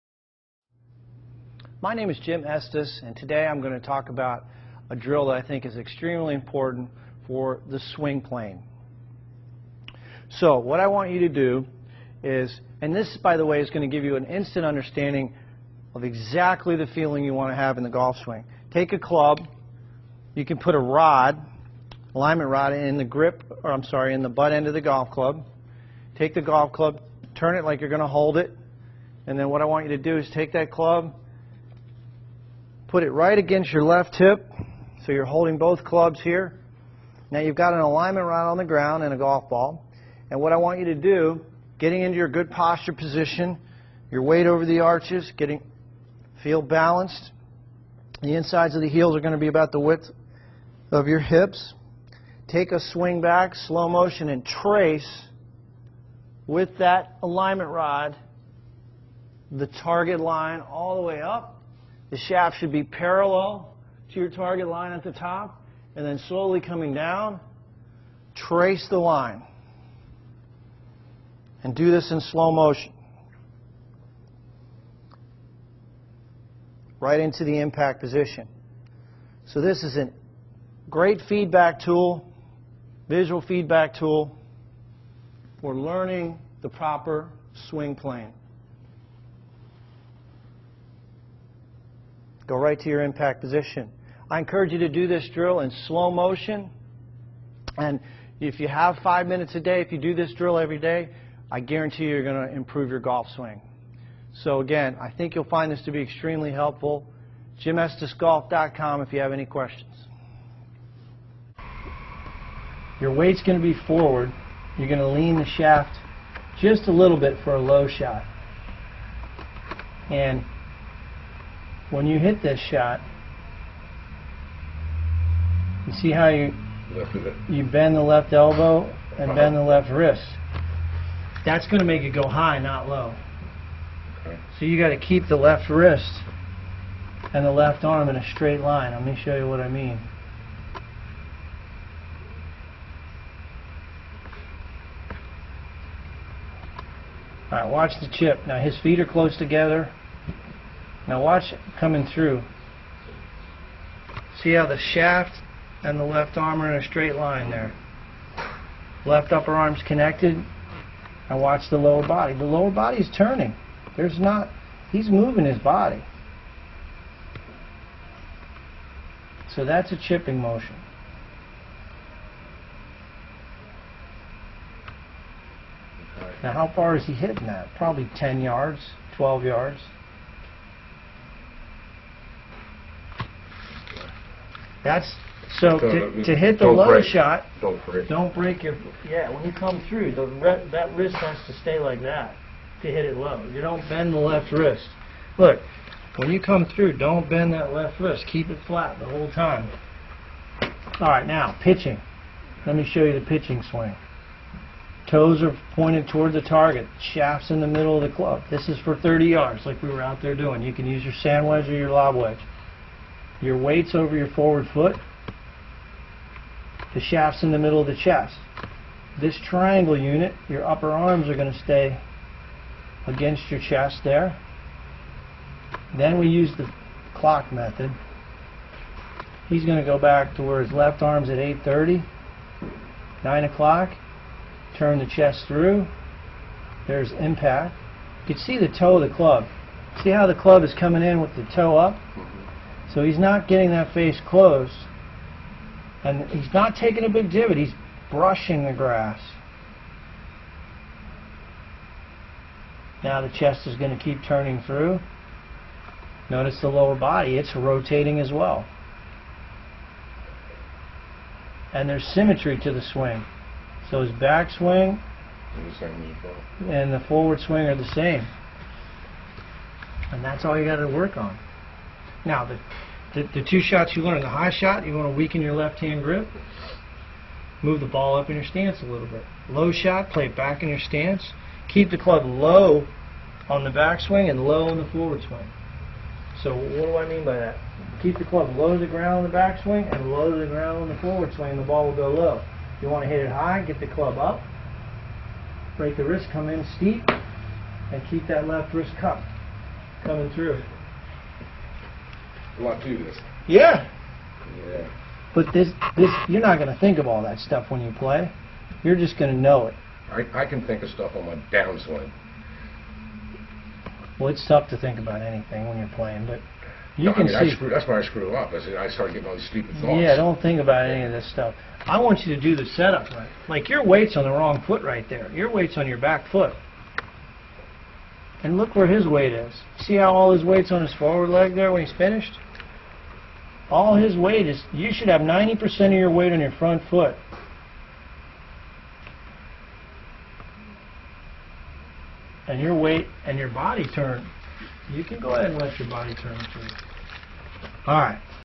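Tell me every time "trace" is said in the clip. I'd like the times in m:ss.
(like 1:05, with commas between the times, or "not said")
0:54, 1:08.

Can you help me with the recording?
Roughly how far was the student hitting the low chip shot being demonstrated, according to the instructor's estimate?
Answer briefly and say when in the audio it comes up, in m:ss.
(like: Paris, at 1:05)
10 to 12 yards, at 2:58.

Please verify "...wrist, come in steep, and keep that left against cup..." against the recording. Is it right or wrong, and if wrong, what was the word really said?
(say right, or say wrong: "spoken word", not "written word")
wrong: "wrist", not "against".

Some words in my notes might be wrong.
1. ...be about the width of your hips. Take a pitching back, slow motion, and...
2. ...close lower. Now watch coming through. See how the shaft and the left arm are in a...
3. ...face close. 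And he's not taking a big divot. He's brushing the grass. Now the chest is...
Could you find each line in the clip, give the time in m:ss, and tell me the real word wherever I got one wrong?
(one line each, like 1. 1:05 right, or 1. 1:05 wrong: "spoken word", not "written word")
1. 0:49 wrong: "swing", not "pitching"
2. 2:29 wrong: "together", not "lower"
3. 4:03 right.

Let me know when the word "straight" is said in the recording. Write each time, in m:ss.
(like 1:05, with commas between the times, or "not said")
2:18, 2:36.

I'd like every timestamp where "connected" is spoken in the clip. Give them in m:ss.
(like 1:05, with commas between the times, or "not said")
2:39.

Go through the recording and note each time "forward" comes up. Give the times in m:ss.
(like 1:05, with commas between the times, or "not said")
1:53, 3:34, 4:27, 4:44, 4:51, 5:30.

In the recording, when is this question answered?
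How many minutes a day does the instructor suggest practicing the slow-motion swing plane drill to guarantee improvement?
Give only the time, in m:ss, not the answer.
1:39.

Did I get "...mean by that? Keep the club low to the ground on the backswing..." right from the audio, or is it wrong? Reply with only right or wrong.
right.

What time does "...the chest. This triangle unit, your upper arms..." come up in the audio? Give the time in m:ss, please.
3:37.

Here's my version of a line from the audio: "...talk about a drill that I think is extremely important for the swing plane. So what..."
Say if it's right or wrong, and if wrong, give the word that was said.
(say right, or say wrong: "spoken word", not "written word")
right.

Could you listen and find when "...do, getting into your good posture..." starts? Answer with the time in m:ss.
0:40.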